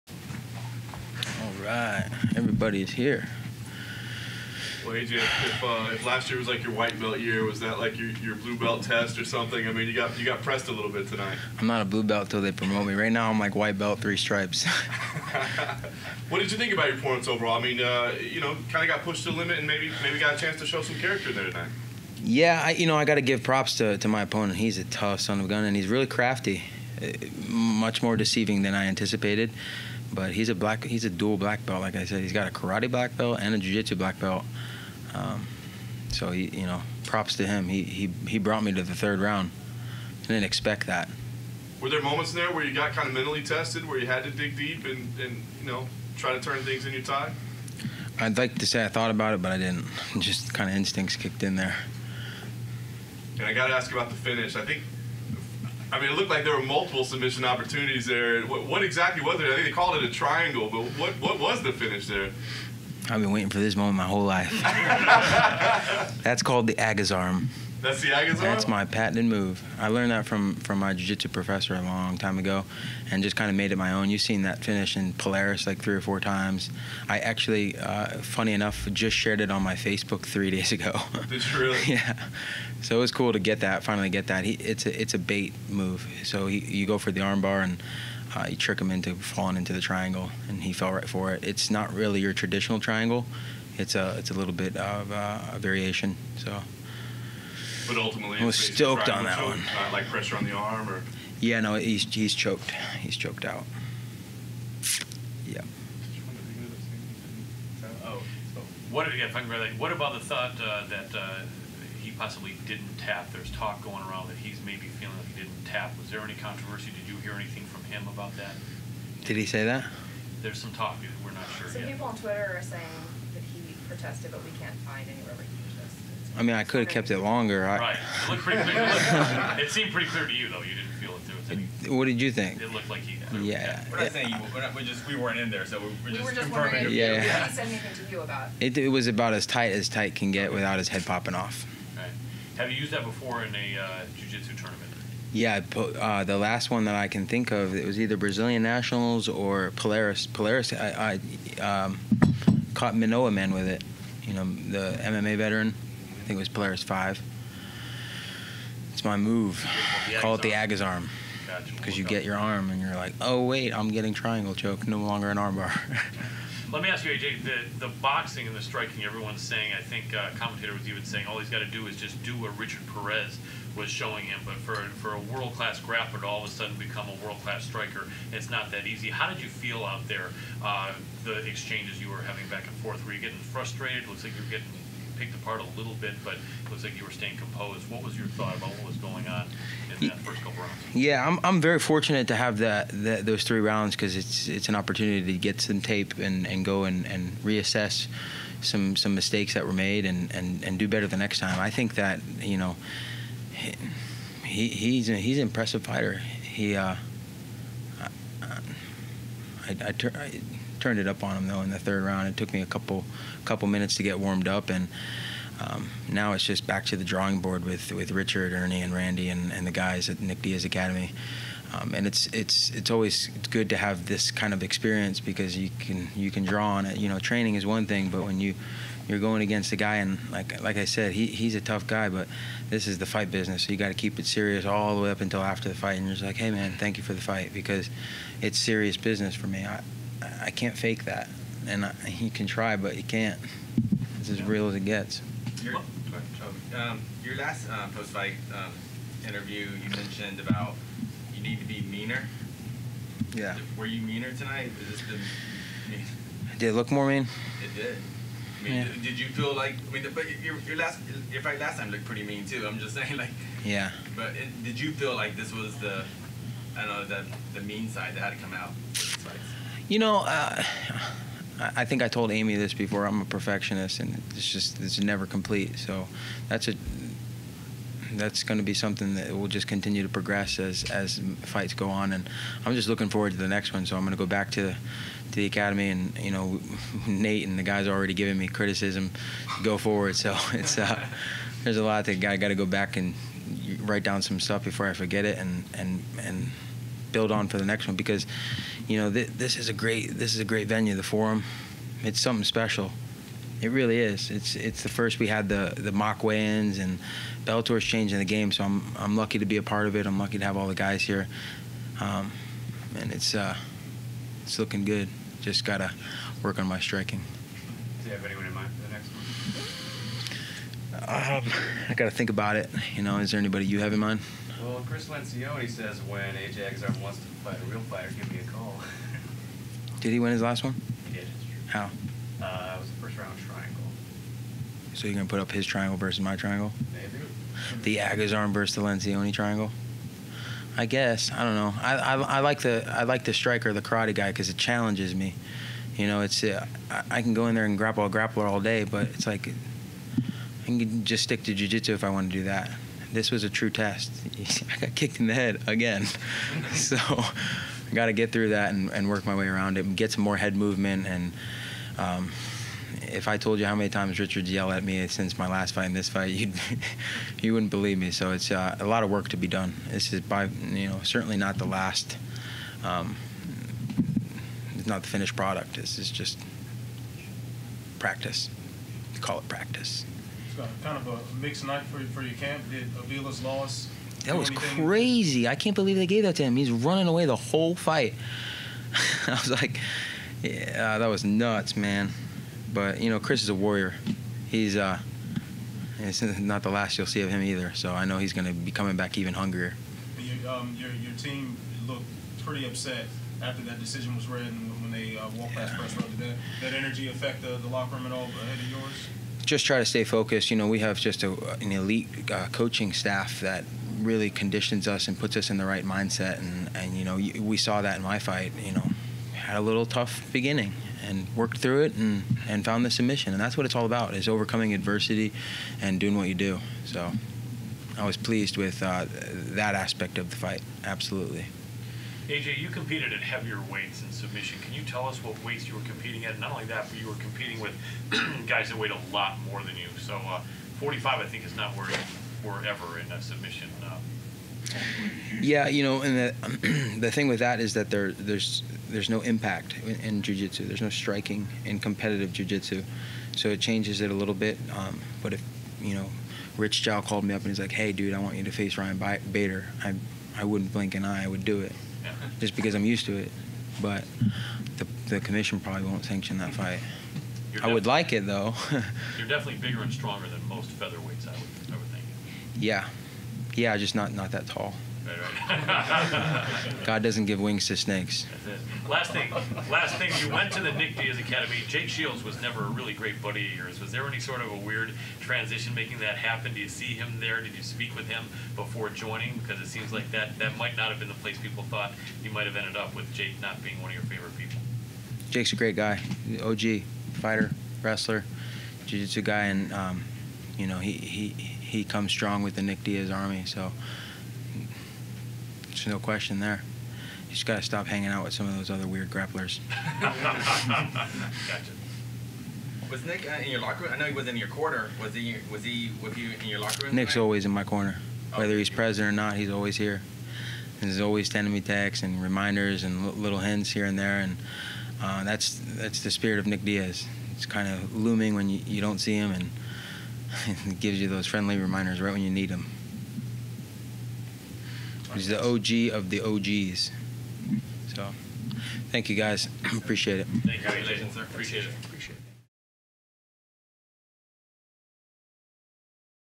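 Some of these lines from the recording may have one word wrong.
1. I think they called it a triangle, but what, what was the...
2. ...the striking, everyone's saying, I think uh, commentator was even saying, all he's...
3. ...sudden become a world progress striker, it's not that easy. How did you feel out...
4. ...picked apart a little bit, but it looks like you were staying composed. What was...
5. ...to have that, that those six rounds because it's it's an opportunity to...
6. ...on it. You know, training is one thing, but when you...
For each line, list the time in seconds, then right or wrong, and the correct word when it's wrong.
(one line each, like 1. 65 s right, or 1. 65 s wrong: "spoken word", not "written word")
1. 59 s right
2. 168 s right
3. 176 s wrong: "class", not "progress"
4. 185 s right
5. 192 s wrong: "three", not "six"
6. 226 s right.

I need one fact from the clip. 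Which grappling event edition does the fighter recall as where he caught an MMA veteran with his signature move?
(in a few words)
Polaris 5.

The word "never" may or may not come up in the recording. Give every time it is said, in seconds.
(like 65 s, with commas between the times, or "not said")
275 s, 482 s.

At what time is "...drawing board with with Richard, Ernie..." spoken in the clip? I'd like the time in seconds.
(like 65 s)
217 s.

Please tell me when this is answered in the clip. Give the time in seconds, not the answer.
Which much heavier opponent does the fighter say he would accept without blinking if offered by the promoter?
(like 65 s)
458 s.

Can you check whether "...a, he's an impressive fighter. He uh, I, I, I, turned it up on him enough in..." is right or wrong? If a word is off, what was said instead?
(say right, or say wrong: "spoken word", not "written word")
wrong: "though", not "enough".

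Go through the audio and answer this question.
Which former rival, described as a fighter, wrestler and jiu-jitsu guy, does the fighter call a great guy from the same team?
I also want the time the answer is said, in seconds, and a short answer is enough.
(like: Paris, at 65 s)
Jake Shields, at 481 s.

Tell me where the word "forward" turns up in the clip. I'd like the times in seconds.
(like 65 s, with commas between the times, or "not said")
283 s, 289 s.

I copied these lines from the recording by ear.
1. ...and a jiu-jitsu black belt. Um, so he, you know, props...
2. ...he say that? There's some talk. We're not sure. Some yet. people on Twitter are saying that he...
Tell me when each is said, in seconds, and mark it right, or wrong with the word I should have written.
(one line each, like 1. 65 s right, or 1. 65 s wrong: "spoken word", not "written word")
1. 33 s right
2. 119 s right.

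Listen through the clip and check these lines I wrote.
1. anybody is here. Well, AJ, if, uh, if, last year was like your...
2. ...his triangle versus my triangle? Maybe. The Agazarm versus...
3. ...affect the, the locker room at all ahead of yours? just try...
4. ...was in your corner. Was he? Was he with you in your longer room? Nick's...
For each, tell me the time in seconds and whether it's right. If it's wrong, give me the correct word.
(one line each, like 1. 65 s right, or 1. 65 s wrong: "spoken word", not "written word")
1. 2 s wrong: "everybody", not "anybody"
2. 335 s right
3. 407 s right
4. 514 s wrong: "locker", not "longer".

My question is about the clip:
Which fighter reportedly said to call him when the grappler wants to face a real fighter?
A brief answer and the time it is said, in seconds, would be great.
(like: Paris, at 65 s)
Chris Lencioni, at 324 s.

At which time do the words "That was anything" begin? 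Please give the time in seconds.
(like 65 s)
384 s.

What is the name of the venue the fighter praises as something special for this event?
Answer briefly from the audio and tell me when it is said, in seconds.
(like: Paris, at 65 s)
The Forum, at 300 s.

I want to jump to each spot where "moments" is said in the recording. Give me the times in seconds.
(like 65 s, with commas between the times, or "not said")
42 s, 63 s.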